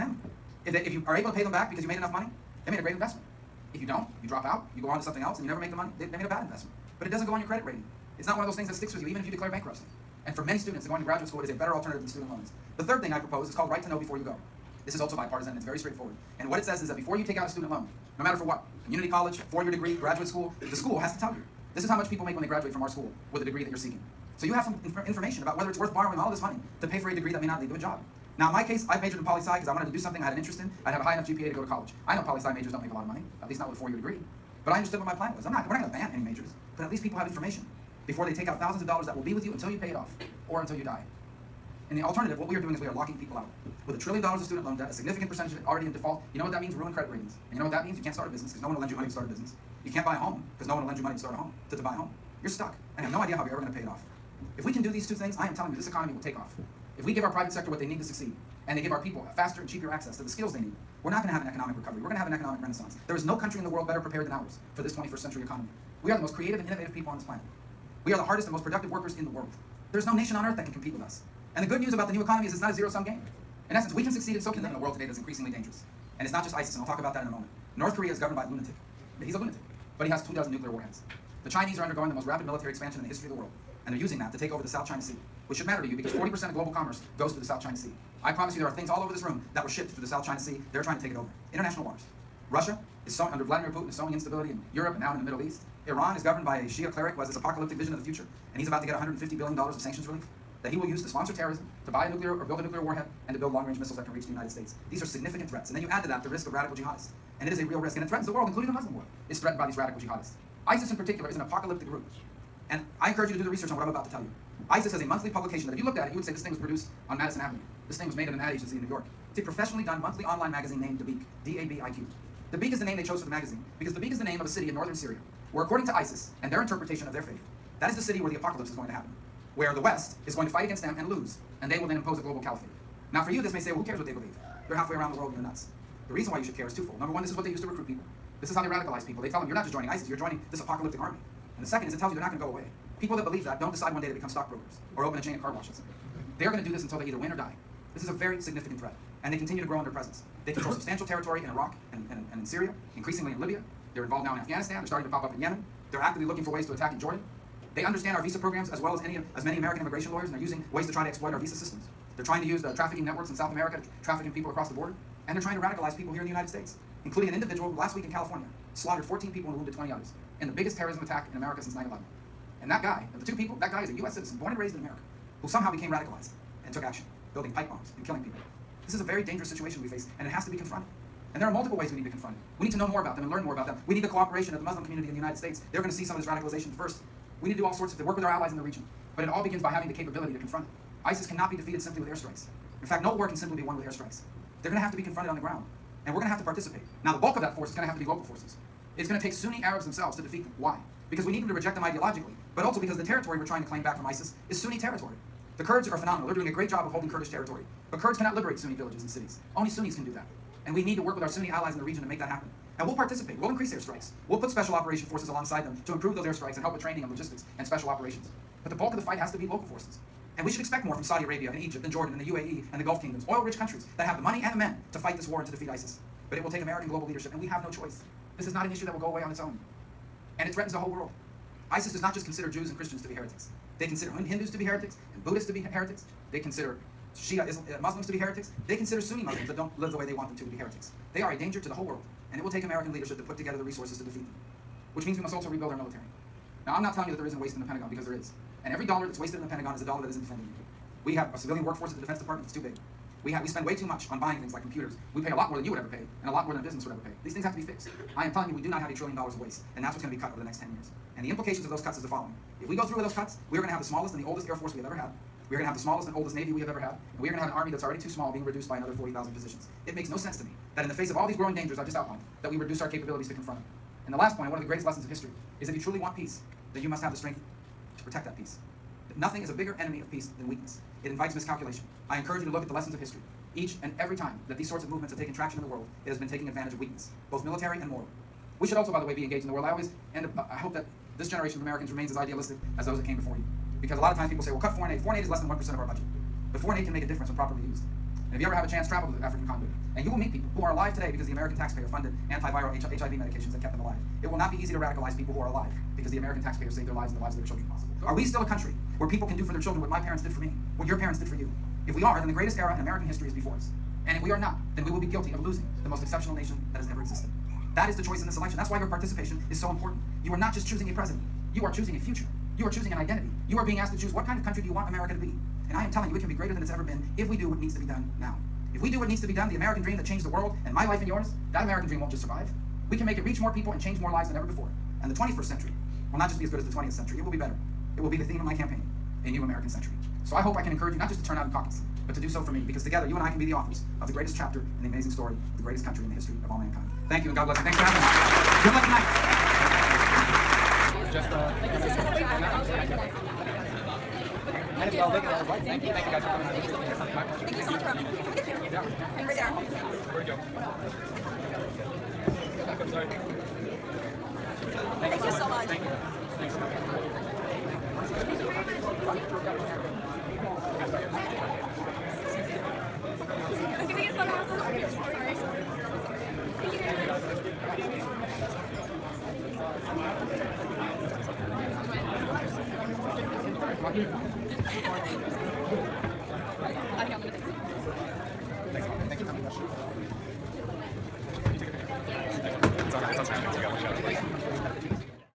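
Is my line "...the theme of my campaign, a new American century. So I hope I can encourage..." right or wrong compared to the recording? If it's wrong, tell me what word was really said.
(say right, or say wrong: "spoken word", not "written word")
right.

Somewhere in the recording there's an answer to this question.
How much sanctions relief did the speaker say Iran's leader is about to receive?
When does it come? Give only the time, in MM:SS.
01:38.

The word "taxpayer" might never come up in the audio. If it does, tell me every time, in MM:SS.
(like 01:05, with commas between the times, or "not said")
05:01, 05:06.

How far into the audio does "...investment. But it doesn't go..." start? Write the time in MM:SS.
00:06.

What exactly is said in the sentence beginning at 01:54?
ISIS has a monthly publication that if you looked at it, you would say this thing was produced on Madison Avenue.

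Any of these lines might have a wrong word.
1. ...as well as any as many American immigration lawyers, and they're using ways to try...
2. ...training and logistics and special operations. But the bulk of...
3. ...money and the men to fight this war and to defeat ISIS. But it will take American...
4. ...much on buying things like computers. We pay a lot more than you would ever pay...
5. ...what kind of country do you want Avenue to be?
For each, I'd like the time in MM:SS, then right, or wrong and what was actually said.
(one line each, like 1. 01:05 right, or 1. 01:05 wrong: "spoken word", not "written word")
1. 02:38 right
2. 03:36 right
3. 03:44 right
4. 04:13 right
5. 05:24 wrong: "America", not "Avenue".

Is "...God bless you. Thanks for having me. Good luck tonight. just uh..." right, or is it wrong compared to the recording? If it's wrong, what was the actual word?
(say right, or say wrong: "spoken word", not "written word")
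right.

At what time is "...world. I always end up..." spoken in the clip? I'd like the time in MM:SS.
04:49.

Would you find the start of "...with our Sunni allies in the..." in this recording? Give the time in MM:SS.
03:31.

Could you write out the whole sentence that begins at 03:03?
We need the cooperation of the Muslim community in the United States.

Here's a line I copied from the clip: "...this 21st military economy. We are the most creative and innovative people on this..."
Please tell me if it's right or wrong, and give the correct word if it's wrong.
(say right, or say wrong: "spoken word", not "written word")
wrong: "century", not "military".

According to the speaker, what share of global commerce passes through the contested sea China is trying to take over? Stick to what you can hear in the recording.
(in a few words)
40%.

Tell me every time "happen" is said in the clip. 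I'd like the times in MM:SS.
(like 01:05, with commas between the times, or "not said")
02:08, 03:32.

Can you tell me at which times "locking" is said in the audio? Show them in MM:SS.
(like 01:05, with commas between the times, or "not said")
00:42.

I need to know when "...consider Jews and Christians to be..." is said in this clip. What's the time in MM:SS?
03:52.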